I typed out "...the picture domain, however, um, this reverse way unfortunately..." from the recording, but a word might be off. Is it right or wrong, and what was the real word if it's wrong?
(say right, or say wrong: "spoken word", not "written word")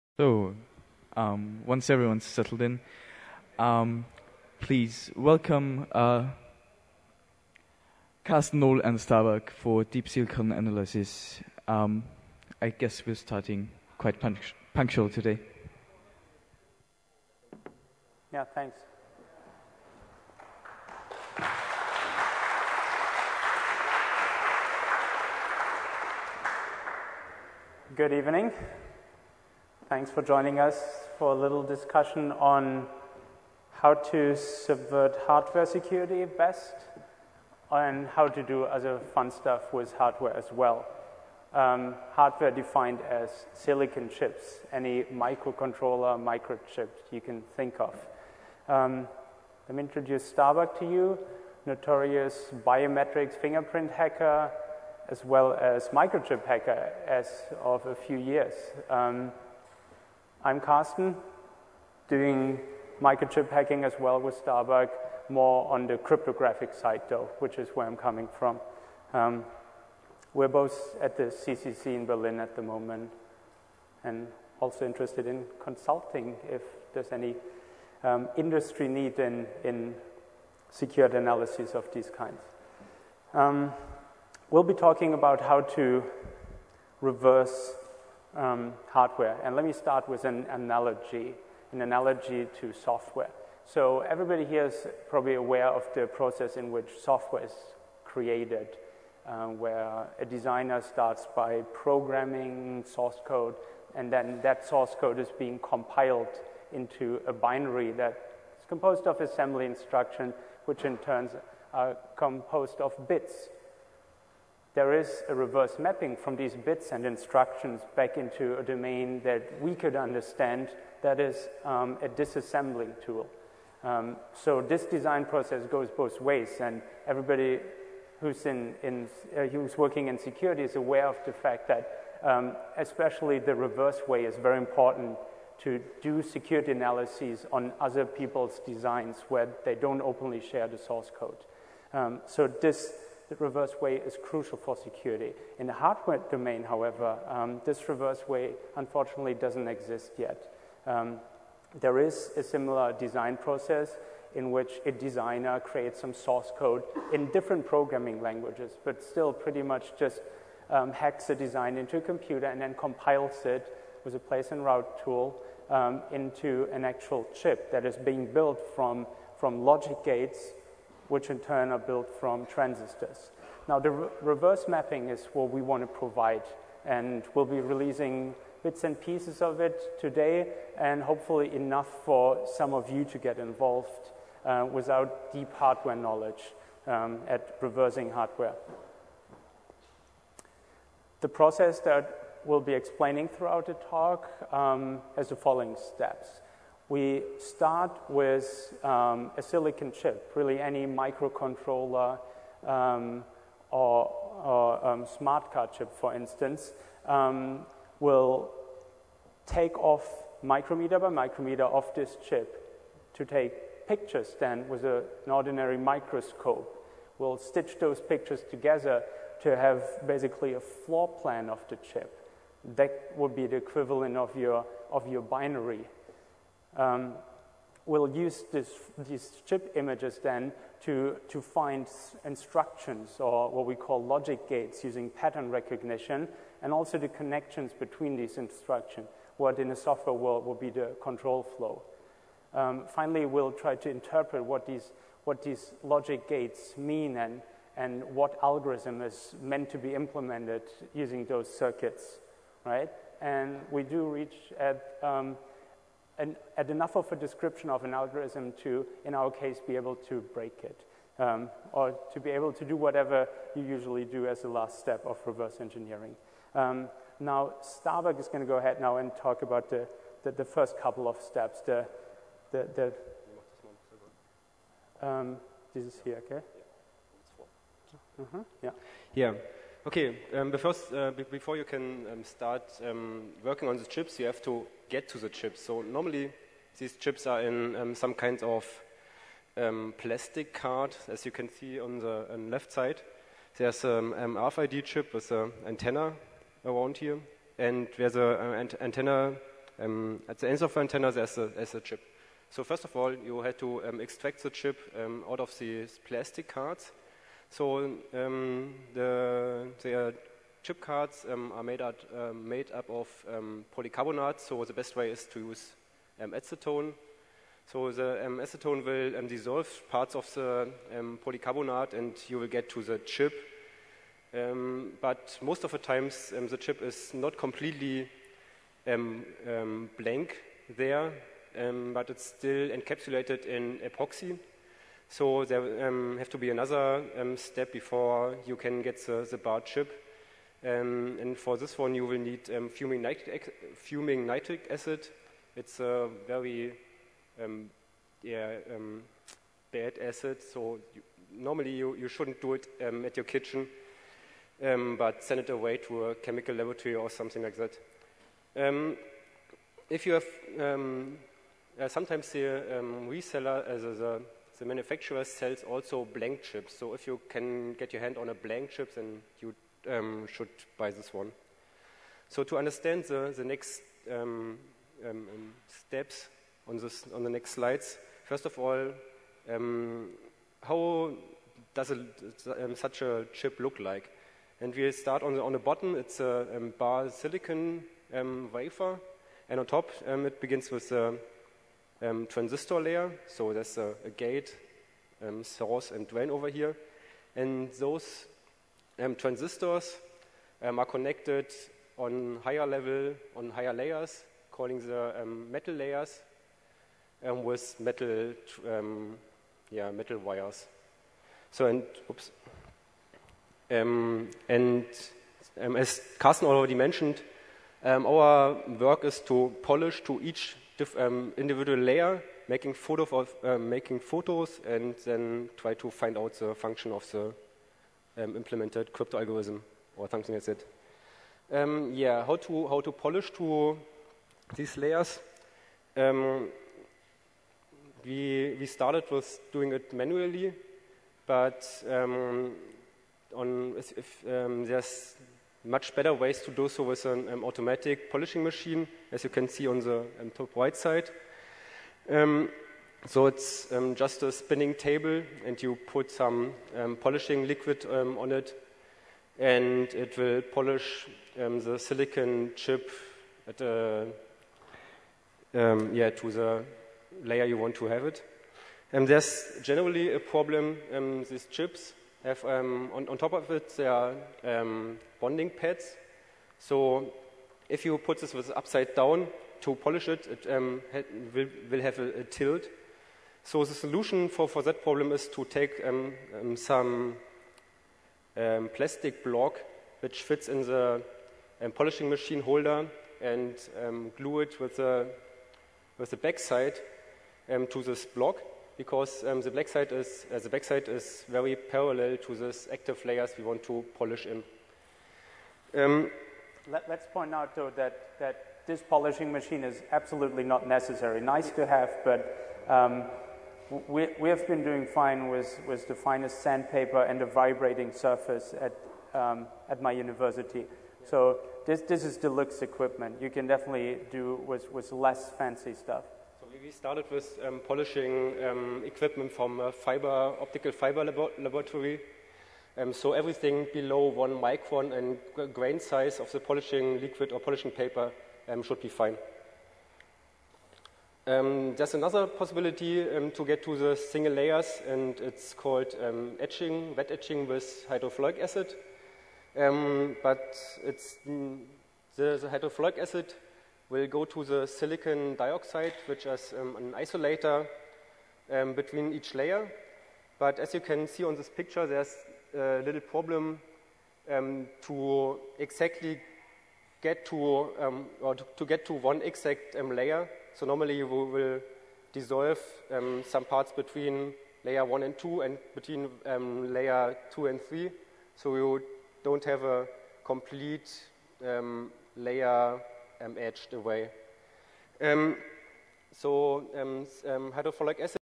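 wrong: "hardware", not "picture".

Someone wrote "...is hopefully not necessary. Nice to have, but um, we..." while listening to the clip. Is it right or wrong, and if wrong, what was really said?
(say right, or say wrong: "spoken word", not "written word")
wrong: "absolutely", not "hopefully".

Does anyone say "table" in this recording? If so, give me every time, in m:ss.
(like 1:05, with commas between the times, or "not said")
7:34.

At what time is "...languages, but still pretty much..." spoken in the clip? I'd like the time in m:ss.
2:38.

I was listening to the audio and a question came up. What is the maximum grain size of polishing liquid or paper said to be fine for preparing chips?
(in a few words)
one micron.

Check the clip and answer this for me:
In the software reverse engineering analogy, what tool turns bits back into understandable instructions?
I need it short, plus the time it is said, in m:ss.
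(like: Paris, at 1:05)
disassembling tool, at 2:02.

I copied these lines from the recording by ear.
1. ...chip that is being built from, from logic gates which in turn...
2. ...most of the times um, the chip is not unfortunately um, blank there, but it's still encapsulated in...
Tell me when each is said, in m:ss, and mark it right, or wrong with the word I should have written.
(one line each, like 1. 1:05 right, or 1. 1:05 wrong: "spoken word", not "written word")
1. 2:47 right
2. 5:25 wrong: "completely", not "unfortunately".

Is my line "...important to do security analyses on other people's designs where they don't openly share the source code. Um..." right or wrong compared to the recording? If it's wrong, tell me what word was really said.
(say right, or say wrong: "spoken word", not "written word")
right.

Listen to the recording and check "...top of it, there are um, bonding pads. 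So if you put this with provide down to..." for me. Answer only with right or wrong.
wrong.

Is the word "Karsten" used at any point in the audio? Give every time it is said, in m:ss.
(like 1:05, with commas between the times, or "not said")
0:08, 1:00, 6:56.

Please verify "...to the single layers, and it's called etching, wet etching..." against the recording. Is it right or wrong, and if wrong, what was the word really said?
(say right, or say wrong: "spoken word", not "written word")
right.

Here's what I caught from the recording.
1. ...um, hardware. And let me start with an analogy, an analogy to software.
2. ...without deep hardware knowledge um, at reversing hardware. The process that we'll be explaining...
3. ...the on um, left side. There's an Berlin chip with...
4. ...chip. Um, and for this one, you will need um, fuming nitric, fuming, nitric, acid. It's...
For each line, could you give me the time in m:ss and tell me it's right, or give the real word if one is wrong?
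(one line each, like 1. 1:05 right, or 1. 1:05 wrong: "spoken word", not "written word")
1. 1:28 right
2. 3:04 right
3. 4:51 wrong: "RFID", not "Berlin"
4. 5:39 right.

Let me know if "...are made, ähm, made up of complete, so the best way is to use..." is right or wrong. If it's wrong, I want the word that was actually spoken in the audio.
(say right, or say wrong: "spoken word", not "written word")
wrong: "polycarbonate", not "complete".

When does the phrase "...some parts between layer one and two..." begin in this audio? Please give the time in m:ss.
9:33.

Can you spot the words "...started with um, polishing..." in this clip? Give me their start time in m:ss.
8:46.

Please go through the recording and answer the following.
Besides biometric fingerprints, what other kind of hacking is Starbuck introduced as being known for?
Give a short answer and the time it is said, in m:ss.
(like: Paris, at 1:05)
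microchip hacking, at 0:55.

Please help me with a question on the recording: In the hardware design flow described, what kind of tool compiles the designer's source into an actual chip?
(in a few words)
place and route tool.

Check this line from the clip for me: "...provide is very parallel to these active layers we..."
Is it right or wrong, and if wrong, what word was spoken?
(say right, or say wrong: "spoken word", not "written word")
wrong: "backside", not "provide".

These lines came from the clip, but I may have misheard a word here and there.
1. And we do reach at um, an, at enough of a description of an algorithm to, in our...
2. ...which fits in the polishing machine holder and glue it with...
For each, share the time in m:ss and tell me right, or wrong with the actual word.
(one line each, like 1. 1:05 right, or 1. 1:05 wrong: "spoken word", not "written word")
1. 4:13 right
2. 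8:10 right.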